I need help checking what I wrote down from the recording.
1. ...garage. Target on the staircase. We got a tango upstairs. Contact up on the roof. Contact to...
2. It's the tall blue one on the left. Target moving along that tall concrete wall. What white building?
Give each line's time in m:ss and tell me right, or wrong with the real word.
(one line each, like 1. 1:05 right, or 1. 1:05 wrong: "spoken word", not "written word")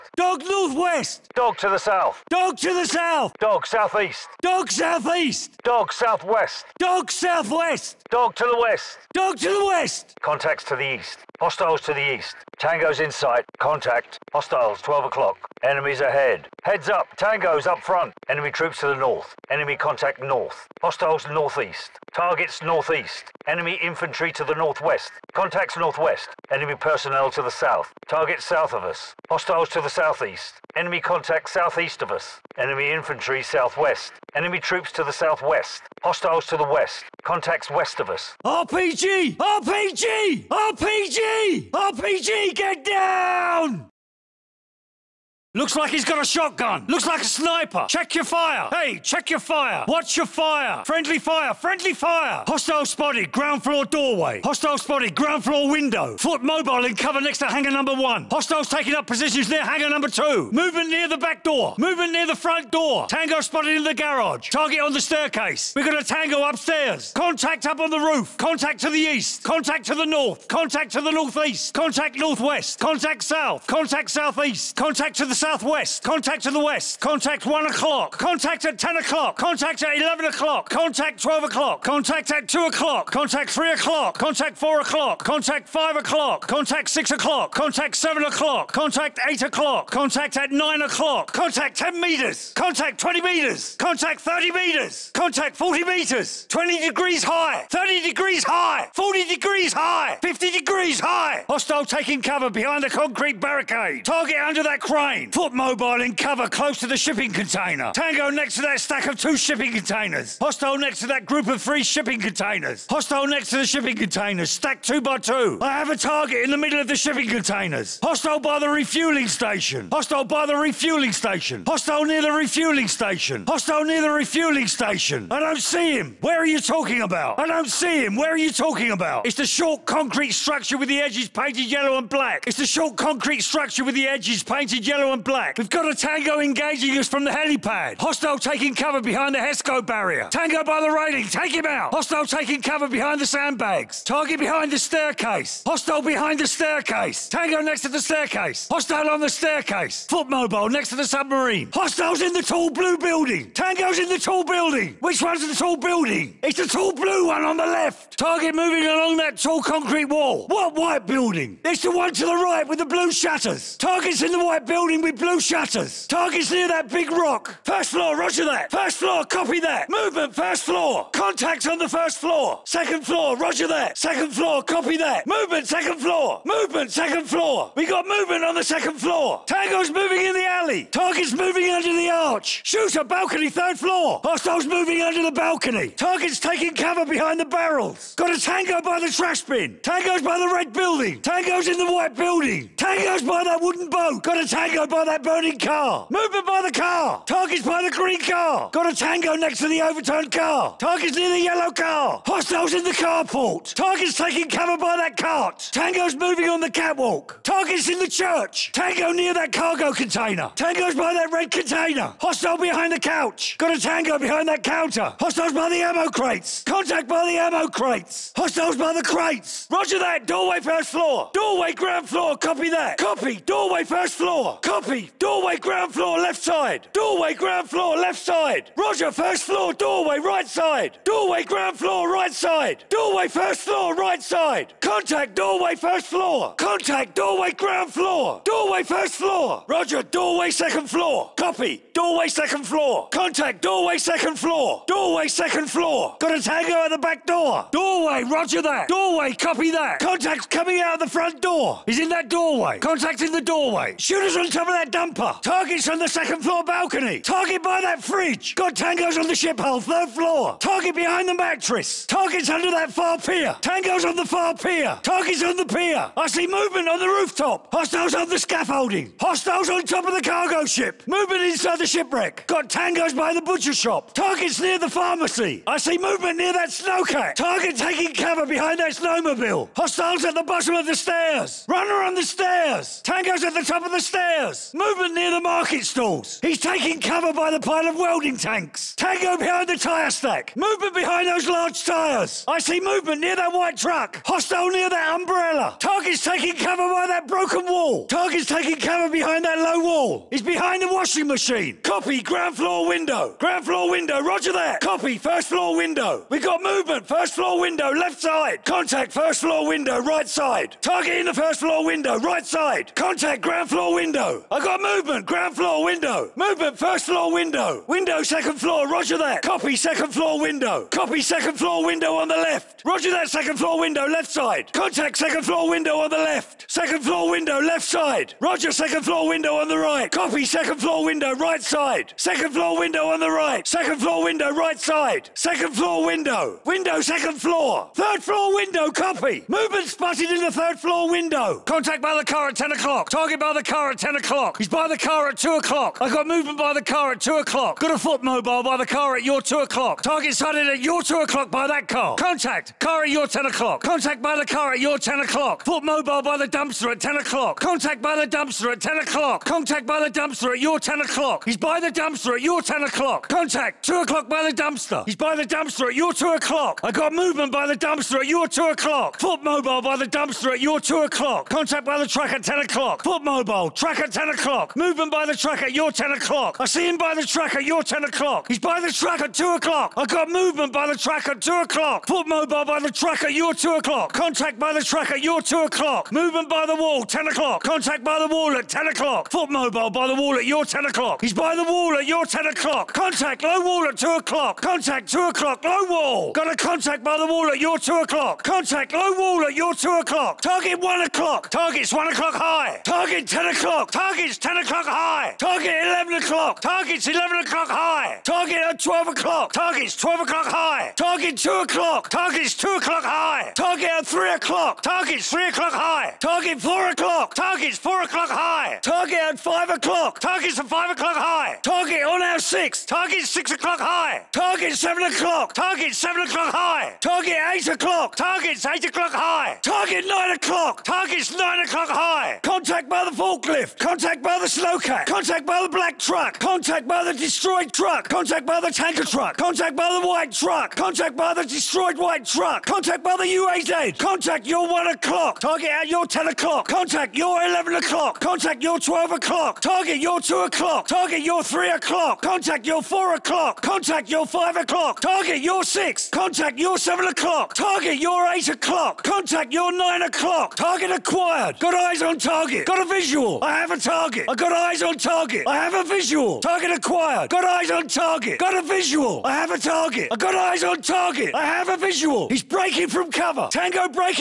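1. 1:03 right
2. 2:36 right.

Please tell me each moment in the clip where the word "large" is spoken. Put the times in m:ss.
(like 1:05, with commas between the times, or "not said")
4:51.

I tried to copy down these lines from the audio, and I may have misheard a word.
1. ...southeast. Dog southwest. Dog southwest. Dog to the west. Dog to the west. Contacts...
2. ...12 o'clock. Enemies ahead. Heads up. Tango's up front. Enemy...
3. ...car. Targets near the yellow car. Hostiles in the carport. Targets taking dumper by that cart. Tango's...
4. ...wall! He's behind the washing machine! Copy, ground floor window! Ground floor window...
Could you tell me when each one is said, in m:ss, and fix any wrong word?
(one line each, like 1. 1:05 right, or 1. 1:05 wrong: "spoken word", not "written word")
1. 0:04 right
2. 0:14 right
3. 3:20 wrong: "cover", not "dumper"
4. 4:59 right.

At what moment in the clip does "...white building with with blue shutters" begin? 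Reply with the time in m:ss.
2:44.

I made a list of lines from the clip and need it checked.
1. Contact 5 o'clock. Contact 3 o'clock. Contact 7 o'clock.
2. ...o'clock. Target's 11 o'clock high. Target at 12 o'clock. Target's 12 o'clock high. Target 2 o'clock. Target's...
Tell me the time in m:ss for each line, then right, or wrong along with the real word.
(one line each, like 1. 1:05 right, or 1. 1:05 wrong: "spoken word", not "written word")
1. 1:25 wrong: "6", not "3"
2. 6:46 right.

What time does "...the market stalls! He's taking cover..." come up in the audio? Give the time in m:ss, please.
4:45.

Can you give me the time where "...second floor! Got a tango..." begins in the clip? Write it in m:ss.
4:05.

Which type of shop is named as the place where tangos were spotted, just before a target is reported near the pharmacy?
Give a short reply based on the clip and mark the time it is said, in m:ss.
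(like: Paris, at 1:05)
Butcher shop, at 4:33.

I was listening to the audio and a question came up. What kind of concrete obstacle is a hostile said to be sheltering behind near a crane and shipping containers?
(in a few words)
Concrete barricade.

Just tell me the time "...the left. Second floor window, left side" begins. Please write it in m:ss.
5:26.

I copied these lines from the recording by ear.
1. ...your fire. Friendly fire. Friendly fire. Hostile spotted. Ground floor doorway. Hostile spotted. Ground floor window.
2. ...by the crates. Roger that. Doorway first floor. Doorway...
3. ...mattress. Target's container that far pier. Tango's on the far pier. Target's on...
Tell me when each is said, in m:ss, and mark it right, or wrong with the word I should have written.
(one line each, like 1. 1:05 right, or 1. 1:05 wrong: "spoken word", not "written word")
1. 0:50 right
2. 3:38 right
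3. 4:21 wrong: "under", not "container".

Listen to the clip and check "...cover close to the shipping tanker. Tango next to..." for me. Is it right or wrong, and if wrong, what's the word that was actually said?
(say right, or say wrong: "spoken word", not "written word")
wrong: "container", not "tanker".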